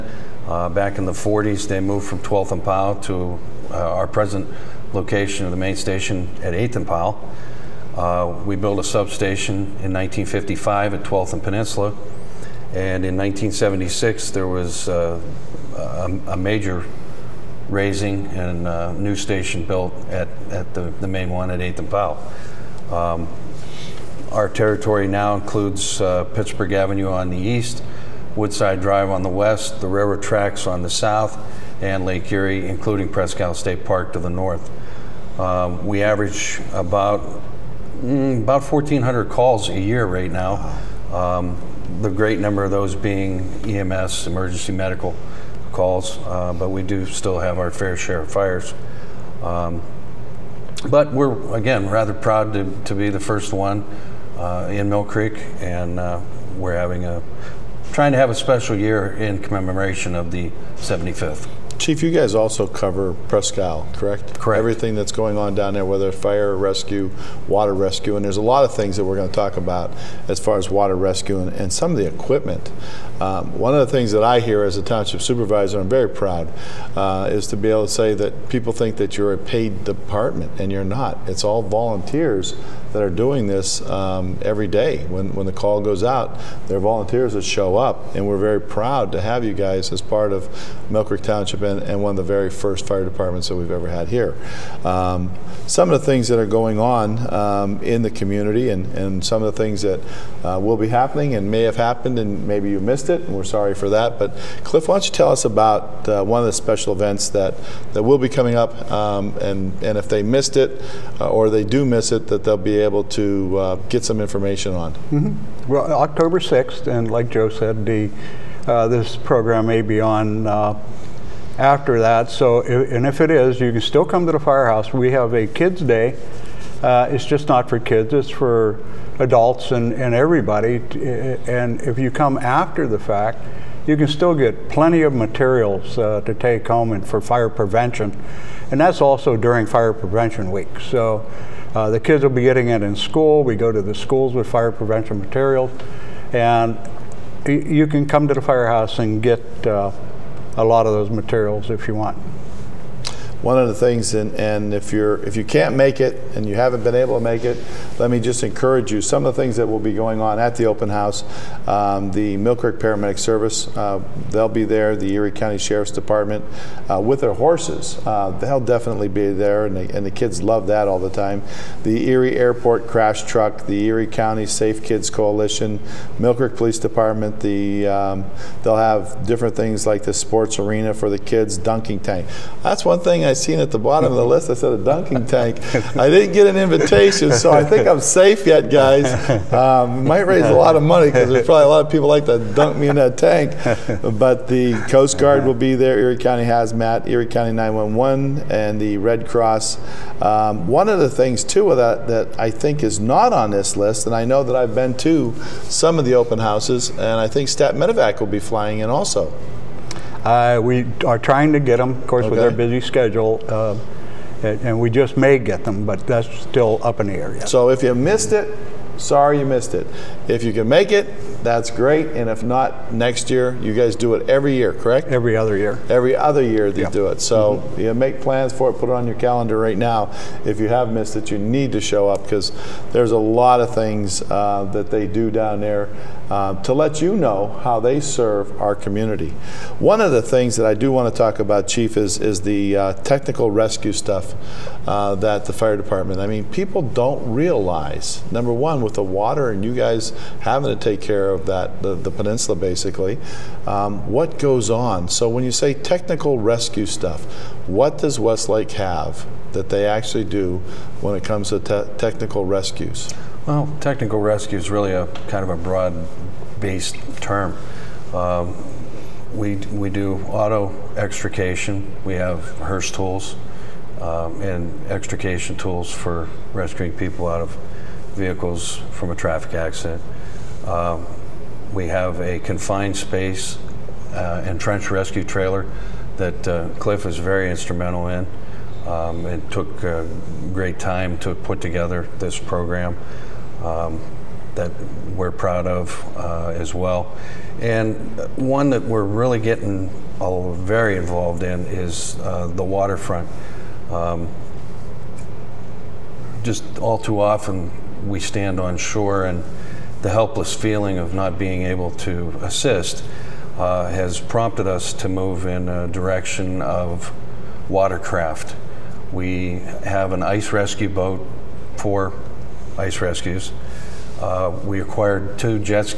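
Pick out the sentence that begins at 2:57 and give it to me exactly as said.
The um, they'll have different things like the sports arena for the kids, dunking tank.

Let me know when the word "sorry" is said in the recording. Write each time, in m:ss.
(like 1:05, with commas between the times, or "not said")
1:43, 3:38.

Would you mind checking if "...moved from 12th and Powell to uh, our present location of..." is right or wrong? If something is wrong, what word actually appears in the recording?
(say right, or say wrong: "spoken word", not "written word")
right.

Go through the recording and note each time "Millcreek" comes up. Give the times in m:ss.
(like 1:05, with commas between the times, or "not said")
0:54, 1:30, 2:42, 2:56.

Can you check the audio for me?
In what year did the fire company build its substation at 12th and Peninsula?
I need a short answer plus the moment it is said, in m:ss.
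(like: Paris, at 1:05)
1955, at 0:09.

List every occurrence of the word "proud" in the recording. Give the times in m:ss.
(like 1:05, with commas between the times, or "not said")
0:52, 1:16, 1:28, 4:55.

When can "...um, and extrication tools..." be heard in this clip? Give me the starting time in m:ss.
4:34.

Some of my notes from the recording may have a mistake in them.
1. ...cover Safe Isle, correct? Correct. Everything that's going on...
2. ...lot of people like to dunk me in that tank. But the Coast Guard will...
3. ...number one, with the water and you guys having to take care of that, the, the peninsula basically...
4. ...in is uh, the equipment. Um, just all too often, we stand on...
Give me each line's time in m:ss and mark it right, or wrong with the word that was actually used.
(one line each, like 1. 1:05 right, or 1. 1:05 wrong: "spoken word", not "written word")
1. 1:02 wrong: "Presque", not "Safe"
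2. 3:11 right
3. 4:08 right
4. 5:01 wrong: "waterfront", not "equipment".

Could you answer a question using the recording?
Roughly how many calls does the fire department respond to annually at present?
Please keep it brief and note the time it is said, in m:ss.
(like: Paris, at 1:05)
1,400, at 0:38.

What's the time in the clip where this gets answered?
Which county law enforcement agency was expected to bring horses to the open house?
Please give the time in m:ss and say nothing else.
2:44.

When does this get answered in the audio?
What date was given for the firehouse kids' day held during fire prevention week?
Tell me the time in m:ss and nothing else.
1:55.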